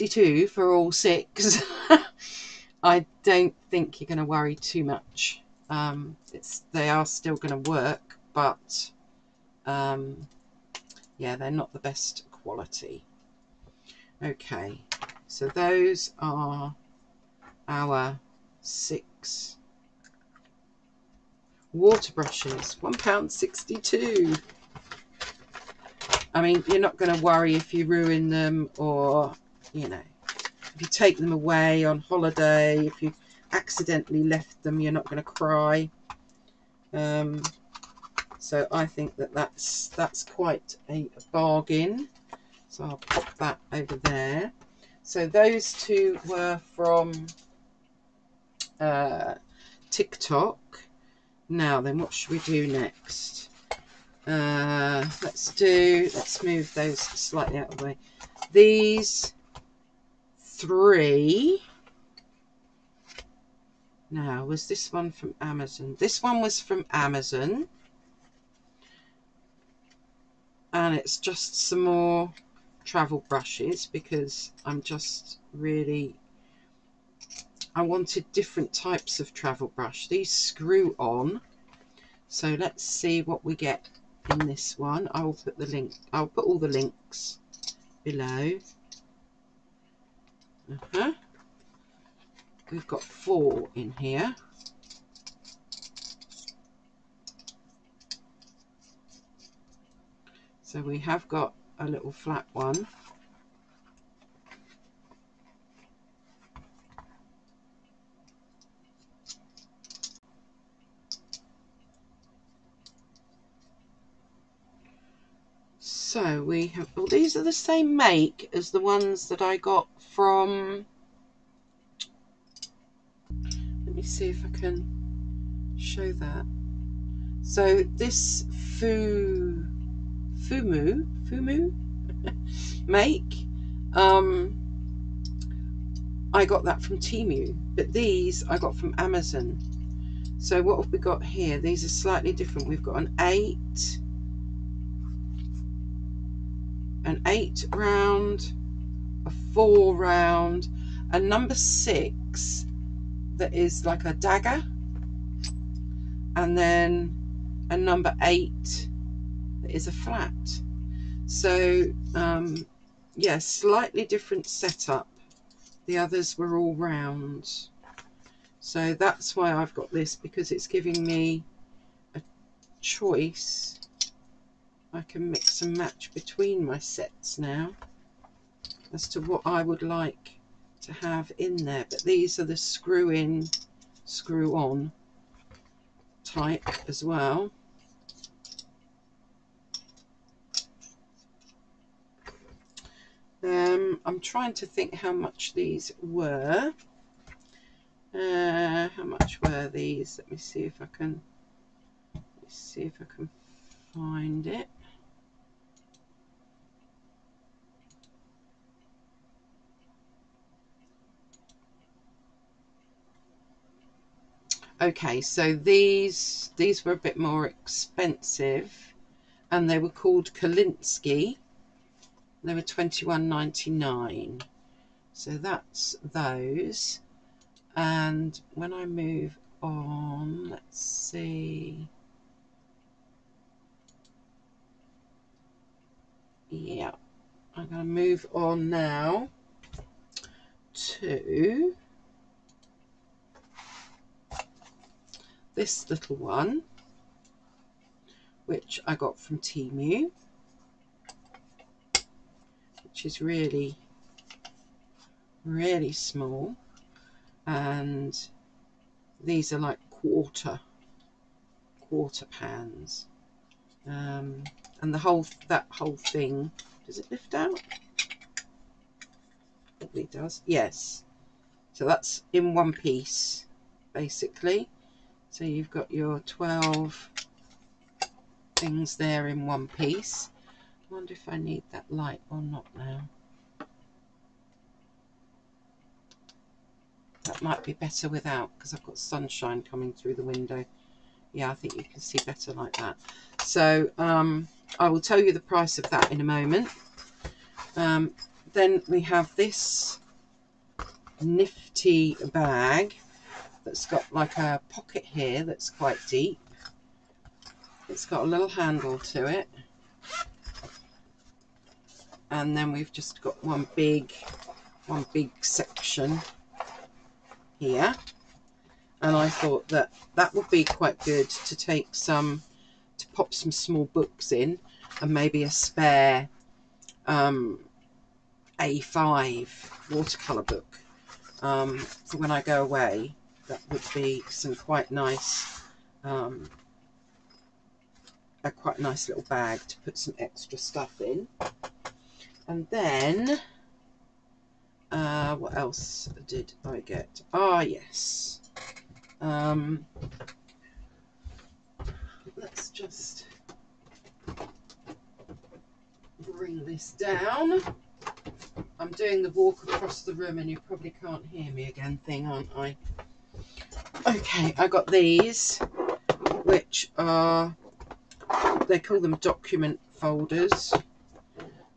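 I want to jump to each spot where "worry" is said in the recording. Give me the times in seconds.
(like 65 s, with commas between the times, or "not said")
4 s, 27 s.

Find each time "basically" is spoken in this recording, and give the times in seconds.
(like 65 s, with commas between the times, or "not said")
273 s.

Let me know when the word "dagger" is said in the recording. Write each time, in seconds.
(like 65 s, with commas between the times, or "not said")
154 s.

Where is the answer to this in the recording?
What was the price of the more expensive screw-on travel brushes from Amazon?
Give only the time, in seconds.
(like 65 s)
222 s.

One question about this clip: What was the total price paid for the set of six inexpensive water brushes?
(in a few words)
£1.62.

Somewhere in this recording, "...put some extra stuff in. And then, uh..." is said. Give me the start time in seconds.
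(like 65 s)
339 s.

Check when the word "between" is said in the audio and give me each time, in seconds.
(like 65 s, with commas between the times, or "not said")
176 s.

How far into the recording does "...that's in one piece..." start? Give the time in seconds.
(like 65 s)
271 s.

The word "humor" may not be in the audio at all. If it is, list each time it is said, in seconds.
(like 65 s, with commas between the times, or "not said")
not said.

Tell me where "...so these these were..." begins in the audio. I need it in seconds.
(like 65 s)
215 s.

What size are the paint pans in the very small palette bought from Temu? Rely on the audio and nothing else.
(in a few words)
Quarter pans.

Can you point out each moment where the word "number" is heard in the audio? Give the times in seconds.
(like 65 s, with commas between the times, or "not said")
151 s, 157 s.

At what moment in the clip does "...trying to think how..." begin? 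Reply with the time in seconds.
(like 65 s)
194 s.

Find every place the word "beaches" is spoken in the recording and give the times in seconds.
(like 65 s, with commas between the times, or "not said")
not said.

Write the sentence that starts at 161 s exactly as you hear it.
So um, yeah, slightly different setup.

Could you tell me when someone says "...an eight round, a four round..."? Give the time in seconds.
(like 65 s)
147 s.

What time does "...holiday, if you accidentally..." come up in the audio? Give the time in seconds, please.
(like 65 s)
31 s.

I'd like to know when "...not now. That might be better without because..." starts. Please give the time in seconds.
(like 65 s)
282 s.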